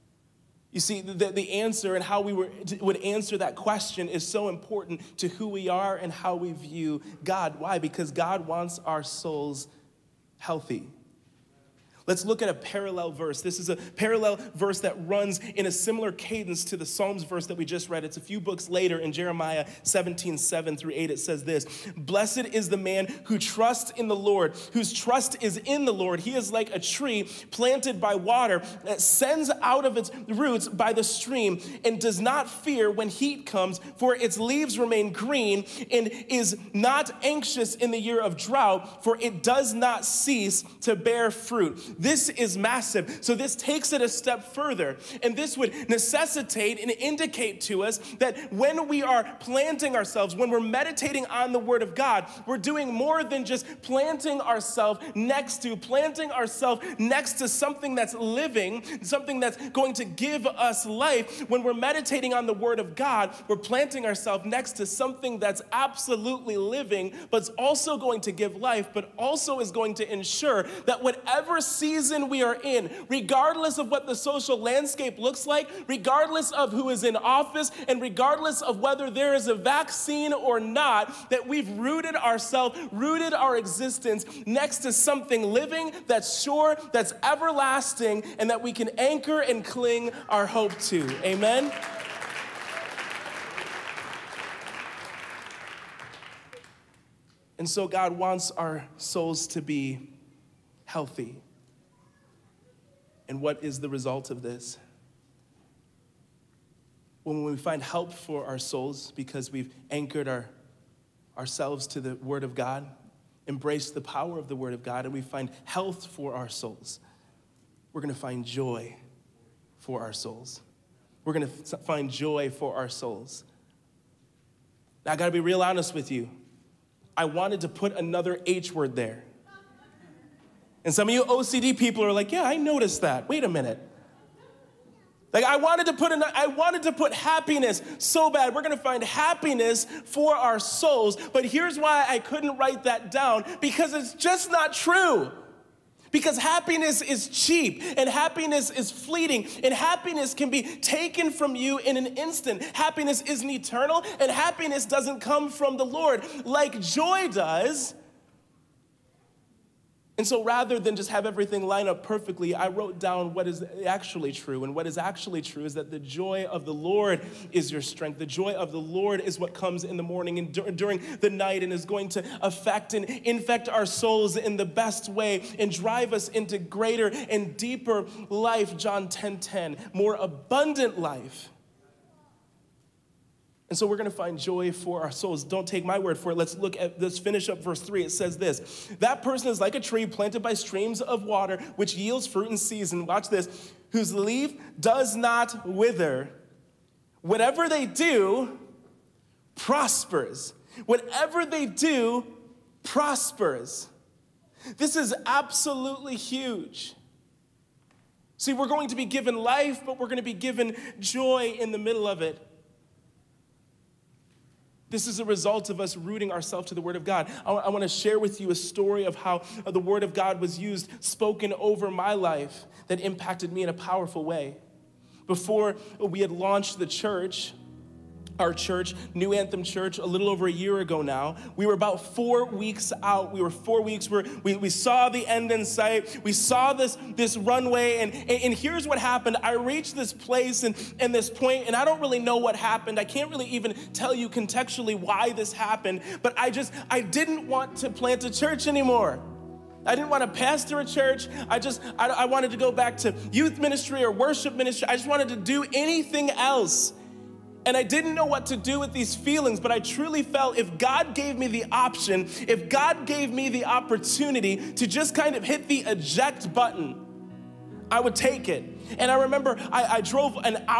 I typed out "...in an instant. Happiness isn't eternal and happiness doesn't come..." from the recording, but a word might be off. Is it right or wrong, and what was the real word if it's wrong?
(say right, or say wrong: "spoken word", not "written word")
right.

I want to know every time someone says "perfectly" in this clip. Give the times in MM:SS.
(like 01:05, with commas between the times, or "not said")
02:42.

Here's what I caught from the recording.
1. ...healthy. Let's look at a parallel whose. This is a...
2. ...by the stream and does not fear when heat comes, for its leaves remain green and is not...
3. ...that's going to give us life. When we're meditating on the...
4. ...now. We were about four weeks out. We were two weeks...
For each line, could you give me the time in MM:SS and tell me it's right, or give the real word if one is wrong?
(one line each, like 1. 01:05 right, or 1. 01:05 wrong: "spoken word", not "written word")
1. 00:10 wrong: "verse", not "whose"
2. 00:30 right
3. 00:59 right
4. 03:51 wrong: "four", not "two".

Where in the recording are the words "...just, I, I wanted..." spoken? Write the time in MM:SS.
04:11.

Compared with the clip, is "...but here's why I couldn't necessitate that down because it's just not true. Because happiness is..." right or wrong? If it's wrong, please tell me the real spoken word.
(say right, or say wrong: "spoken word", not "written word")
wrong: "write", not "necessitate".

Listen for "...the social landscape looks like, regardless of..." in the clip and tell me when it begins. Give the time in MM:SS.
01:14.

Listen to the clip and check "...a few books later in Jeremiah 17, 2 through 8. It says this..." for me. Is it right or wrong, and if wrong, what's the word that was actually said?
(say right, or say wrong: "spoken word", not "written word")
wrong: "7", not "2".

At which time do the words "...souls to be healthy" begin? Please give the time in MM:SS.
01:38.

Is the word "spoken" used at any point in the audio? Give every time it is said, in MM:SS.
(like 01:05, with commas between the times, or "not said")
03:41.